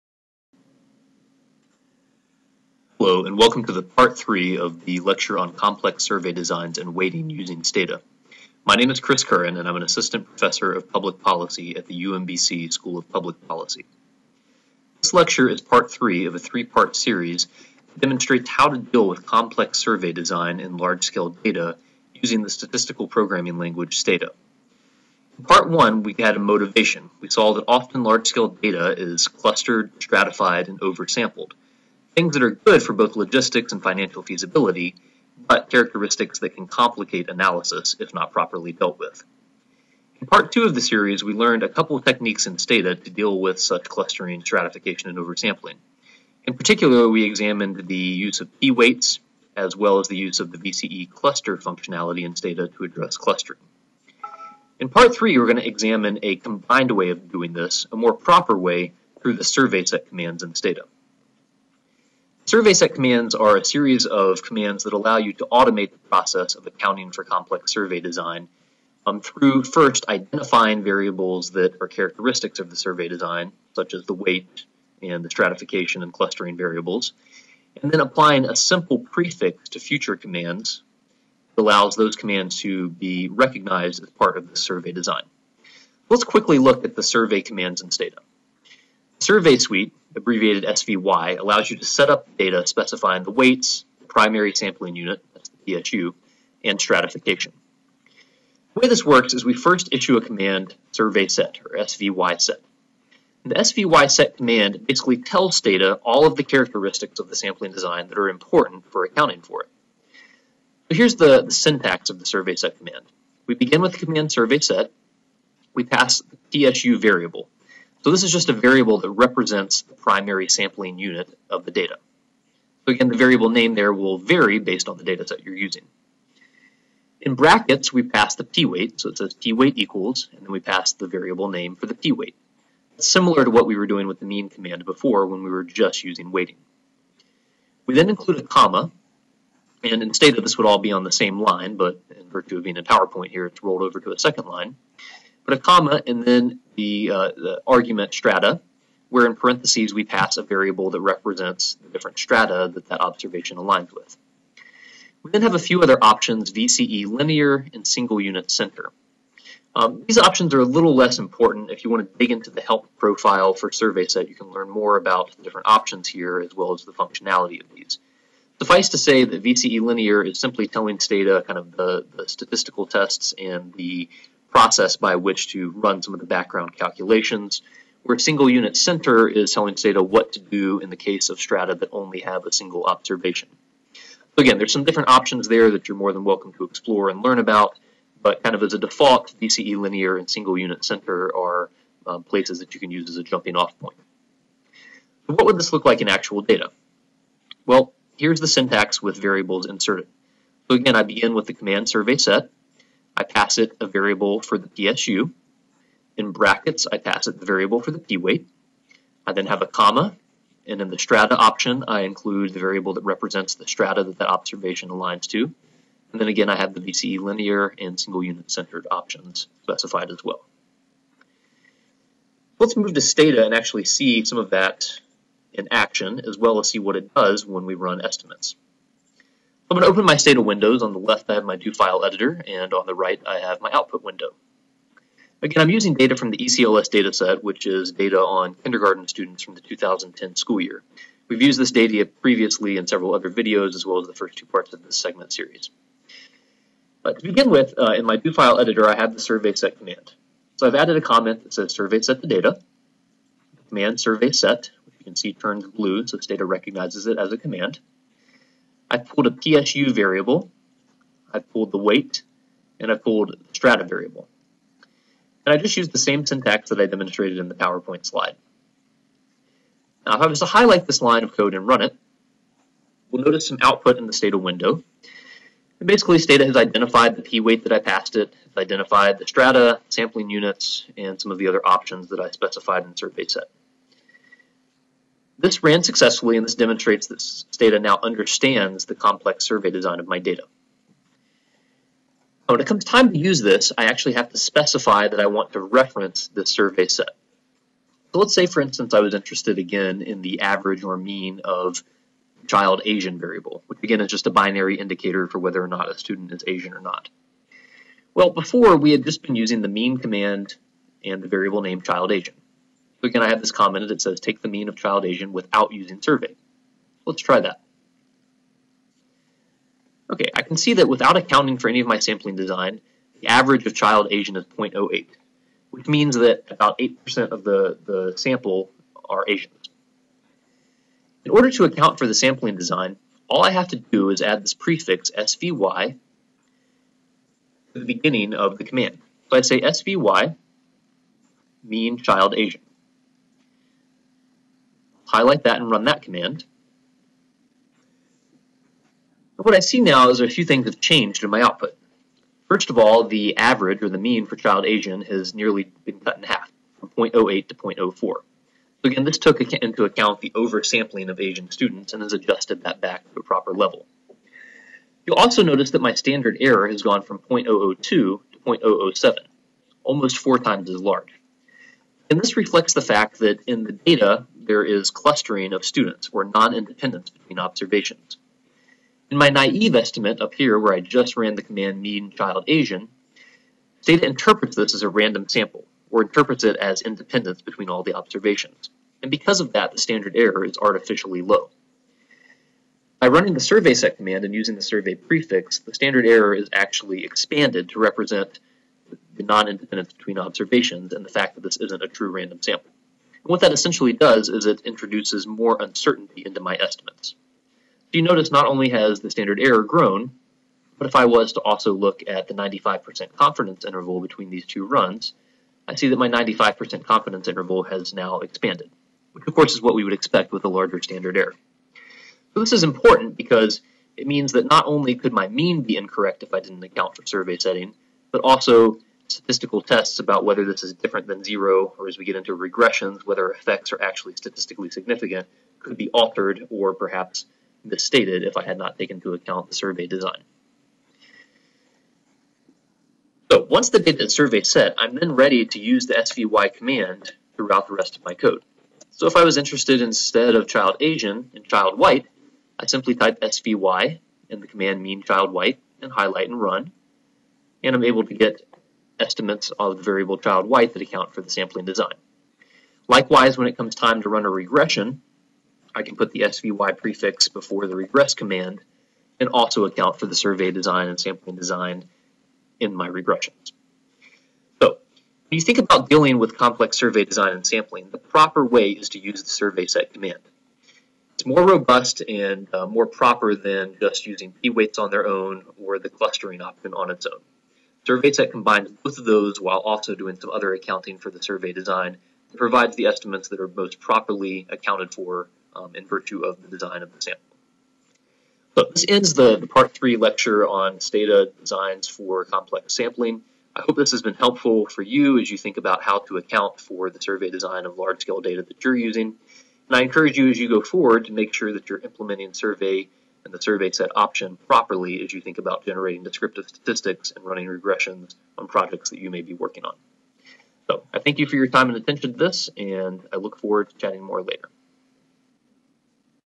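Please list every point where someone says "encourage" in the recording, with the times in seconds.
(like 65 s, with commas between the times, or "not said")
509 s.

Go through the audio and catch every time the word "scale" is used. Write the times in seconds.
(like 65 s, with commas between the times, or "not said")
21 s, 28 s, 507 s.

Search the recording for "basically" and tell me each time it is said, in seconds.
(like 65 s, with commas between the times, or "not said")
104 s, 275 s.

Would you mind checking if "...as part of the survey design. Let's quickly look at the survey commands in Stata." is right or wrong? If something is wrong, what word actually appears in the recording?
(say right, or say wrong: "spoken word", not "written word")
right.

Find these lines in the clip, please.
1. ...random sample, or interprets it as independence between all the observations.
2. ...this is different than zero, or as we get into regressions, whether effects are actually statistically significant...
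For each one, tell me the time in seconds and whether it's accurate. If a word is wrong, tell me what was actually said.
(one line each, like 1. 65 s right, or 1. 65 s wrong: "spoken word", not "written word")
1. 384 s right
2. 430 s right.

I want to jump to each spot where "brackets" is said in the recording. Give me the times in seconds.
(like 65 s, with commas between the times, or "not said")
127 s, 206 s.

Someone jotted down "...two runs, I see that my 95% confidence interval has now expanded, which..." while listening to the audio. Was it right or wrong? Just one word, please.
right.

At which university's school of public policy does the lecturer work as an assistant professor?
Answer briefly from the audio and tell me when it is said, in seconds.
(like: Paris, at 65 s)
UMBC, at 12 s.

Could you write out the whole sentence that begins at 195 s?
So what would this look like in actual data?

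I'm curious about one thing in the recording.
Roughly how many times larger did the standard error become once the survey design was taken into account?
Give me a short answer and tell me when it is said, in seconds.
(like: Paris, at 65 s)
almost four times, at 369 s.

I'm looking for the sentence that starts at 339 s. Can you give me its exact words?
So I say SVY mean child Asian highlight that and run that command.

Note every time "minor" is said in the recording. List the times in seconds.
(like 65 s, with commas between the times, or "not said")
not said.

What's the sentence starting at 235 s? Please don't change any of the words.
Again, I'm using data from the ECLS dataset, which is data on kindergarten students from the 2010 school year.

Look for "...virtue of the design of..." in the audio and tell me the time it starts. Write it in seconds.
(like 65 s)
495 s.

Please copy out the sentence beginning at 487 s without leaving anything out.
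SurveySet combines both of those while also doing some other accounting for the survey design.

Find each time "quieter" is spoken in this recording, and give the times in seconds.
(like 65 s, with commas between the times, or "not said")
not said.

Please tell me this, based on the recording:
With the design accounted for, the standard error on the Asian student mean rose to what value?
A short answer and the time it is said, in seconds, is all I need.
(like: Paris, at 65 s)
0.007, at 368 s.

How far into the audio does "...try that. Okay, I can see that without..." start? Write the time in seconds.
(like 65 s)
317 s.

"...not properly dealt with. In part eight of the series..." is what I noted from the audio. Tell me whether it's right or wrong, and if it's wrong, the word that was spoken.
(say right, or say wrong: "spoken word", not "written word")
wrong: "two", not "eight".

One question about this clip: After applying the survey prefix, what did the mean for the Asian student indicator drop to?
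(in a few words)
0.04.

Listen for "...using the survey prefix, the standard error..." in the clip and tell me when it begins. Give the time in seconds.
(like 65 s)
394 s.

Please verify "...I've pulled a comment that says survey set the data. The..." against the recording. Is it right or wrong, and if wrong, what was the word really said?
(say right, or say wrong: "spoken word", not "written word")
wrong: "added", not "pulled".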